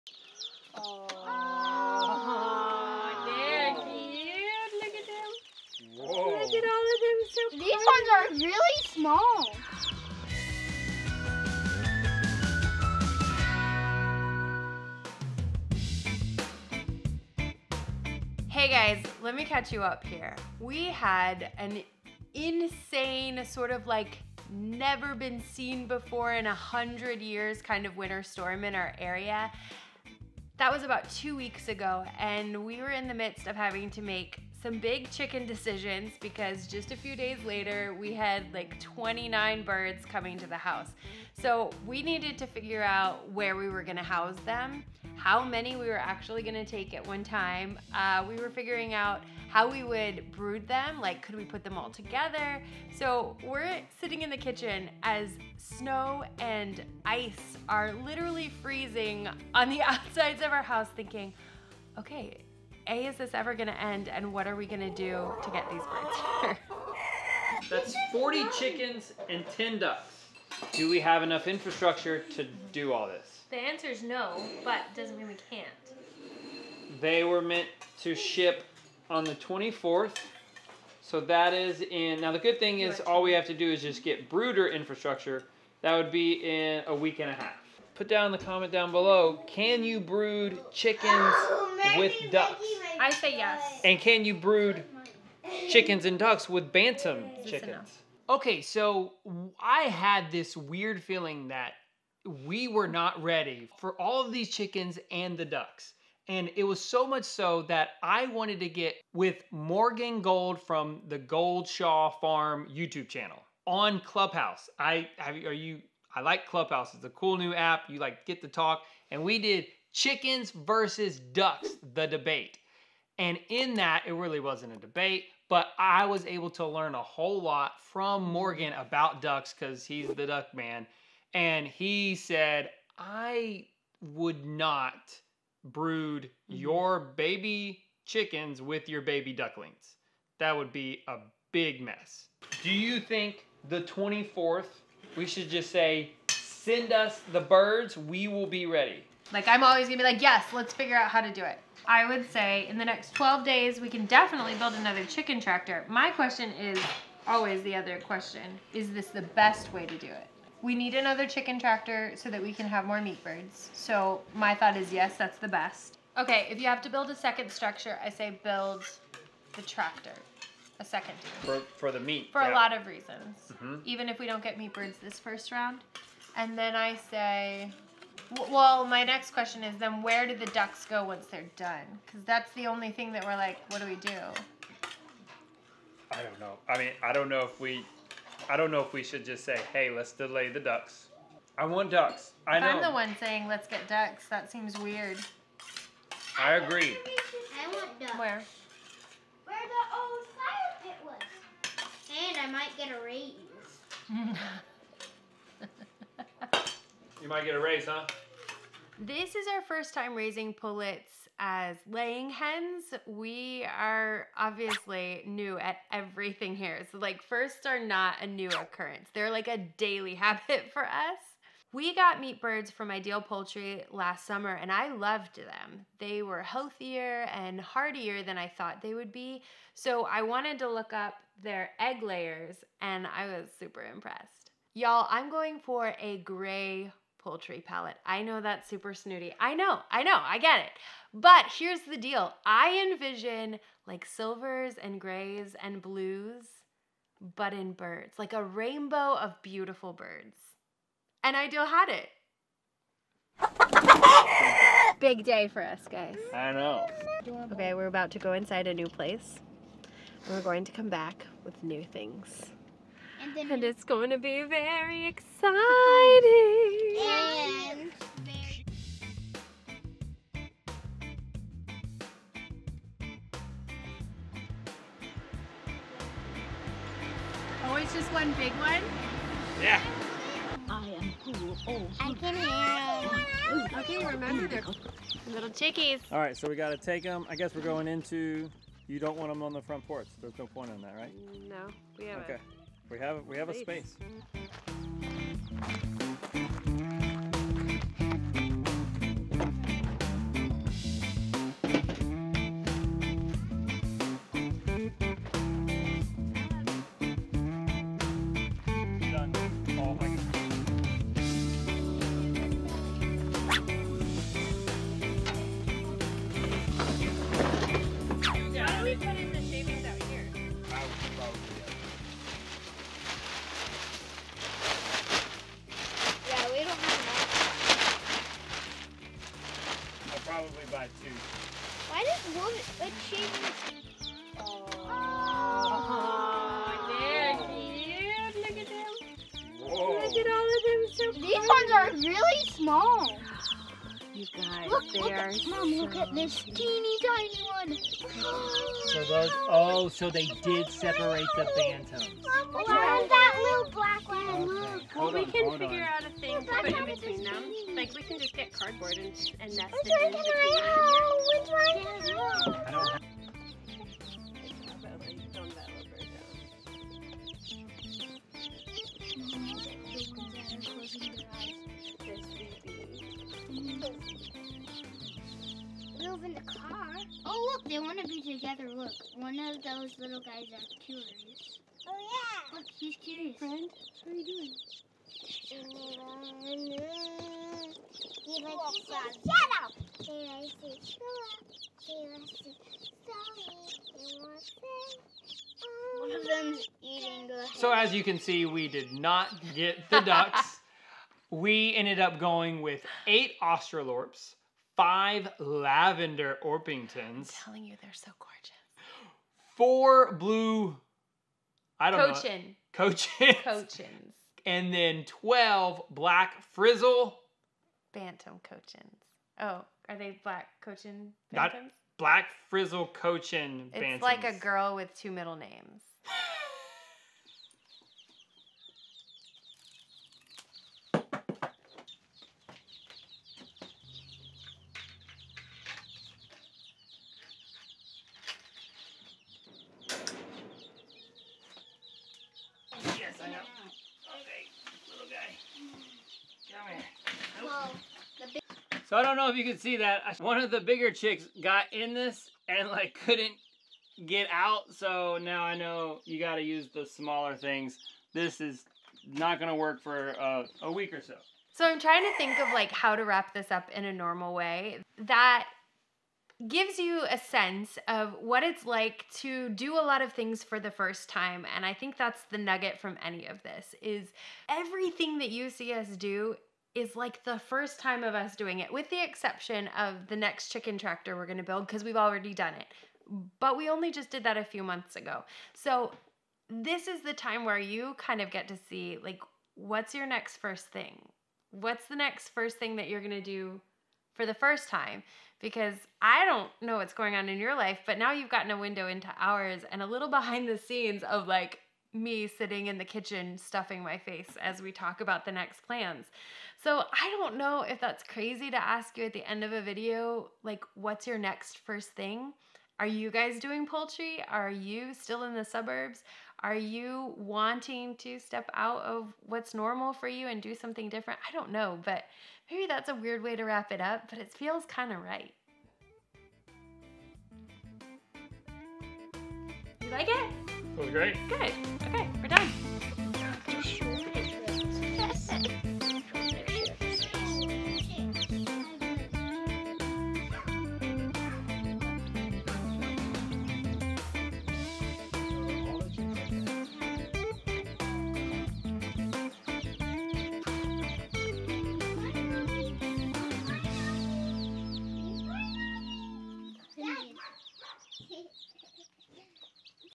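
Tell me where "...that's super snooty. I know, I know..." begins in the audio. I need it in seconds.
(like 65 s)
238 s.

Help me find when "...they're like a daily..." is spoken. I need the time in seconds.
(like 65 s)
219 s.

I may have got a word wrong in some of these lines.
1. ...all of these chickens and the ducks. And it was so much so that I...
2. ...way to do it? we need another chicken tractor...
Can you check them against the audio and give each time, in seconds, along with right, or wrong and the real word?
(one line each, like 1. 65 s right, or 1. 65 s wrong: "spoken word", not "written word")
1. 103 s right
2. 159 s right.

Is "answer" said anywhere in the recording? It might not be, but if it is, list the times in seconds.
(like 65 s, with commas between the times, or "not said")
73 s.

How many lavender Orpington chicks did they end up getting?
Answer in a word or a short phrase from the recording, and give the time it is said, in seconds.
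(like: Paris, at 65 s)
5, at 404 s.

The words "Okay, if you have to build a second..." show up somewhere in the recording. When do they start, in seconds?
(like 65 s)
166 s.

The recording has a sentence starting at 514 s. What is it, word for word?
Are you still in the suburbs?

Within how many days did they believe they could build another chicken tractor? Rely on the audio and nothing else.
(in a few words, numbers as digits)
12.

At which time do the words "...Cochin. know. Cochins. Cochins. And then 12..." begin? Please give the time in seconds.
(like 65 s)
412 s.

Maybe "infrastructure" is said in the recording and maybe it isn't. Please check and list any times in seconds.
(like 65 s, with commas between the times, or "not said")
71 s, 84 s.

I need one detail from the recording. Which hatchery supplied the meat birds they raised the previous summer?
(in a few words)
Ideal Poultry.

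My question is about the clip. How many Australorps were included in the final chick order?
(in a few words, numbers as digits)
8.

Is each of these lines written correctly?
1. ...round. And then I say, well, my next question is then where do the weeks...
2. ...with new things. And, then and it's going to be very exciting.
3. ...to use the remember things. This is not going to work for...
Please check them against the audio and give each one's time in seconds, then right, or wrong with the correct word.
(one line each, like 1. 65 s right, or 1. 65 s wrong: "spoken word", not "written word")
1. 175 s wrong: "ducks", not "weeks"
2. 261 s right
3. 456 s wrong: "smaller", not "remember".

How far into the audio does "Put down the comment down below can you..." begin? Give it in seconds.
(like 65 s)
87 s.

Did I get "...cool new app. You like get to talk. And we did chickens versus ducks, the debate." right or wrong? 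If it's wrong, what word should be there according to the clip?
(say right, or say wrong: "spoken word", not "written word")
right.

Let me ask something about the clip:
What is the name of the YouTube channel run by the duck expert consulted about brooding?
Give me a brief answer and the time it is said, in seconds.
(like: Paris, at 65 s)
Goldshaw Farm, at 111 s.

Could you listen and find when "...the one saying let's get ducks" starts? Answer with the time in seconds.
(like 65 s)
192 s.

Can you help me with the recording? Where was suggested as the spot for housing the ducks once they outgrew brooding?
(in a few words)
Where the old fire pit was.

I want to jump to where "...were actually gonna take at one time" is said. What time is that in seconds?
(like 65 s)
45 s.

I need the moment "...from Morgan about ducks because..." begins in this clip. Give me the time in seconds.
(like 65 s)
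127 s.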